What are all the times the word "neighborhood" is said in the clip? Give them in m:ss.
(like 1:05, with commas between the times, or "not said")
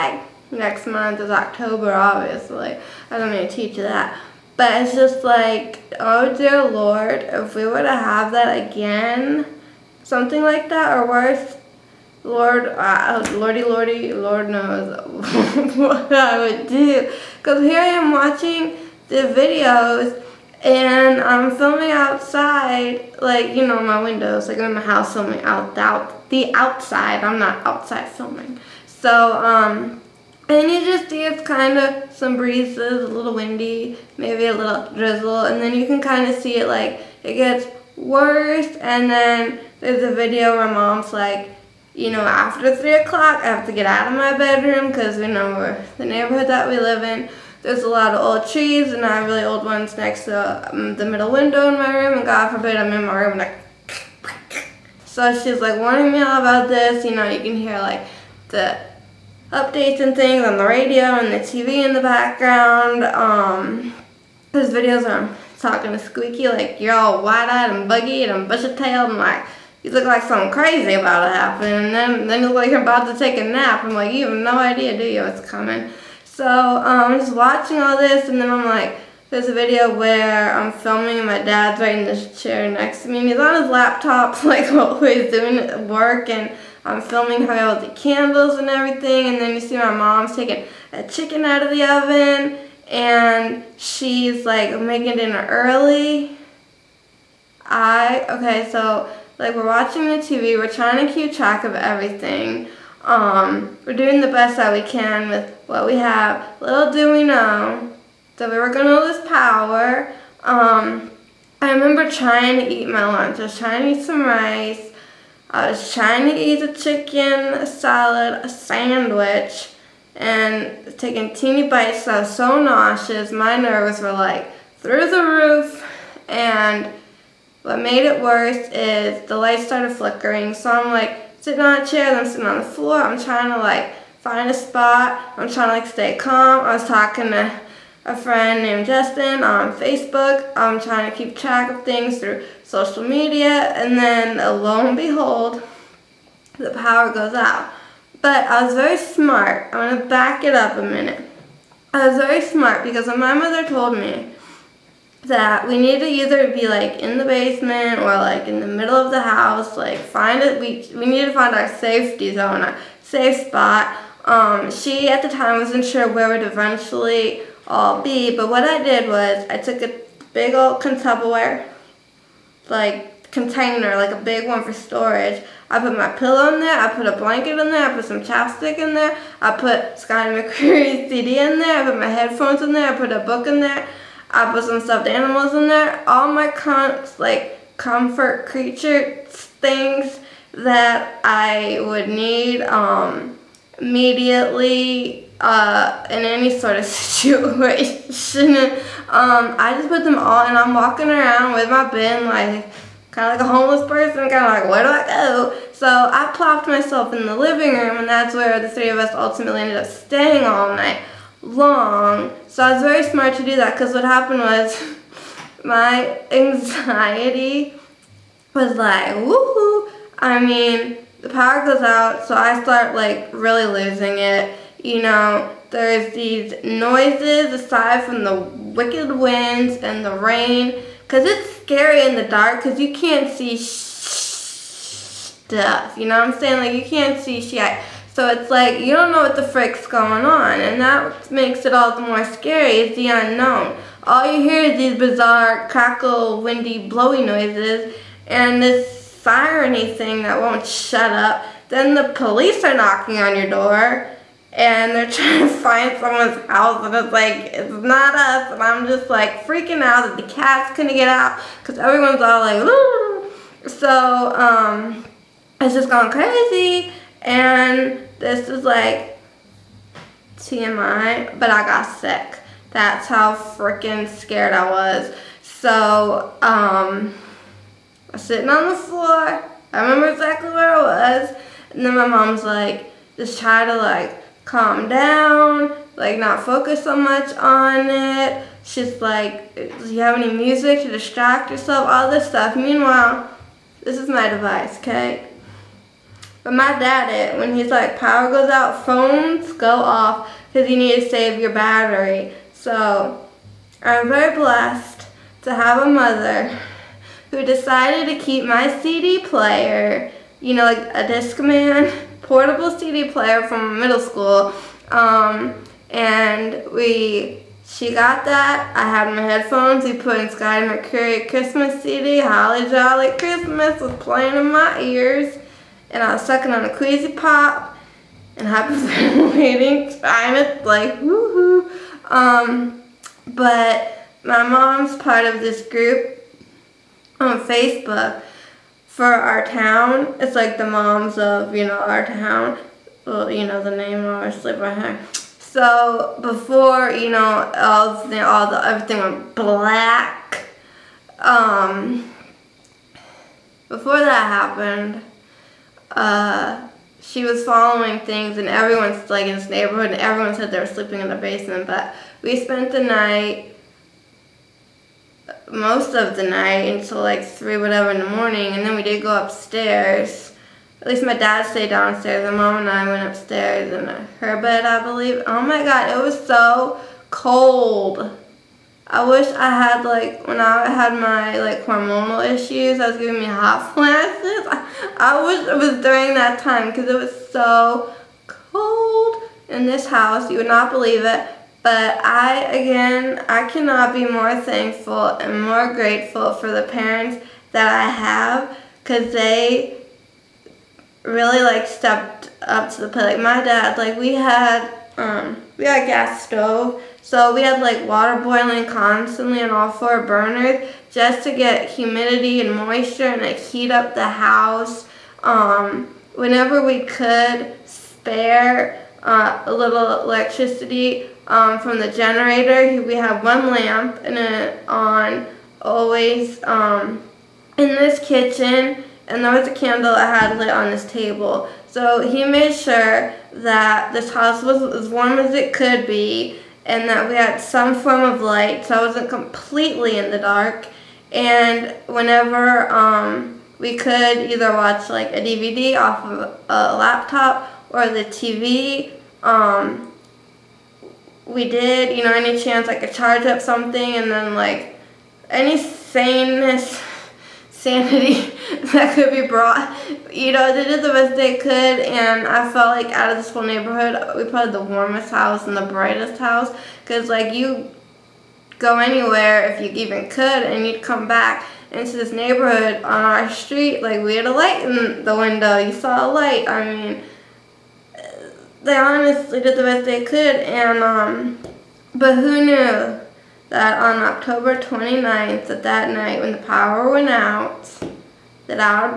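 0:46, 5:59, 7:43, 7:52.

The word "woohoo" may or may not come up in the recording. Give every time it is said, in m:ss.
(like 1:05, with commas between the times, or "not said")
3:39, 5:31.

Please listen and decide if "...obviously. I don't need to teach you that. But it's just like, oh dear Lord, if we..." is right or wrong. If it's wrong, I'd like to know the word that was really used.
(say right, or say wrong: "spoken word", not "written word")
right.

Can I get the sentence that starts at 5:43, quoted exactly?
Well, you know, the name obviously by her.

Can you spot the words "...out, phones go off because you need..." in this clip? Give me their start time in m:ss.
4:58.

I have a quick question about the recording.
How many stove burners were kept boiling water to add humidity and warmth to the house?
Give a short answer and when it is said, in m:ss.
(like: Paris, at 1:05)
4, at 6:49.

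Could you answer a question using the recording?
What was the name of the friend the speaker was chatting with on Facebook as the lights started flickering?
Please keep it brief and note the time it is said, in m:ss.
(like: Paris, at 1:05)
Justin, at 2:18.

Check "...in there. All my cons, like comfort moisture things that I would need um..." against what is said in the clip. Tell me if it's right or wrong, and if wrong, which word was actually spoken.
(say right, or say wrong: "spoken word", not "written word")
wrong: "creature", not "moisture".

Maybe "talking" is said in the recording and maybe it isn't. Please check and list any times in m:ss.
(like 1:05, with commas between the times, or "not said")
1:05, 2:16.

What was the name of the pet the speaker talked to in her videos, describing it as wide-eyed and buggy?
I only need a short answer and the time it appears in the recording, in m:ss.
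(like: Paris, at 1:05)
Squeaky, at 1:05.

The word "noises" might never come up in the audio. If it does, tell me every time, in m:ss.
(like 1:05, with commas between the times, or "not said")
3:46, 4:07.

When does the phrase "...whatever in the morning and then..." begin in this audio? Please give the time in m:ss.
6:07.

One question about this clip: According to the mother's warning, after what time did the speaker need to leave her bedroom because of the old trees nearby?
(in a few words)
3 o'clock.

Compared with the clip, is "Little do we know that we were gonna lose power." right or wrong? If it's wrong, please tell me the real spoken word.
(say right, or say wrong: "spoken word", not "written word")
right.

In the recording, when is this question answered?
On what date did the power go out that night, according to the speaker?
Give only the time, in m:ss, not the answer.
8:04.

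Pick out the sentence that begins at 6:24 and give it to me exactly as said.
I, I wish it was during that time because it was so cold in this house.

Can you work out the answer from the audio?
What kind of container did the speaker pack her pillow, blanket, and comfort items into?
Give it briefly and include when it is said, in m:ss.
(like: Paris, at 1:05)
Tupperware, at 2:50.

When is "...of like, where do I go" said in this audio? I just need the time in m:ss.
3:24.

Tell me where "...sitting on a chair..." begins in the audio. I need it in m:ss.
2:11.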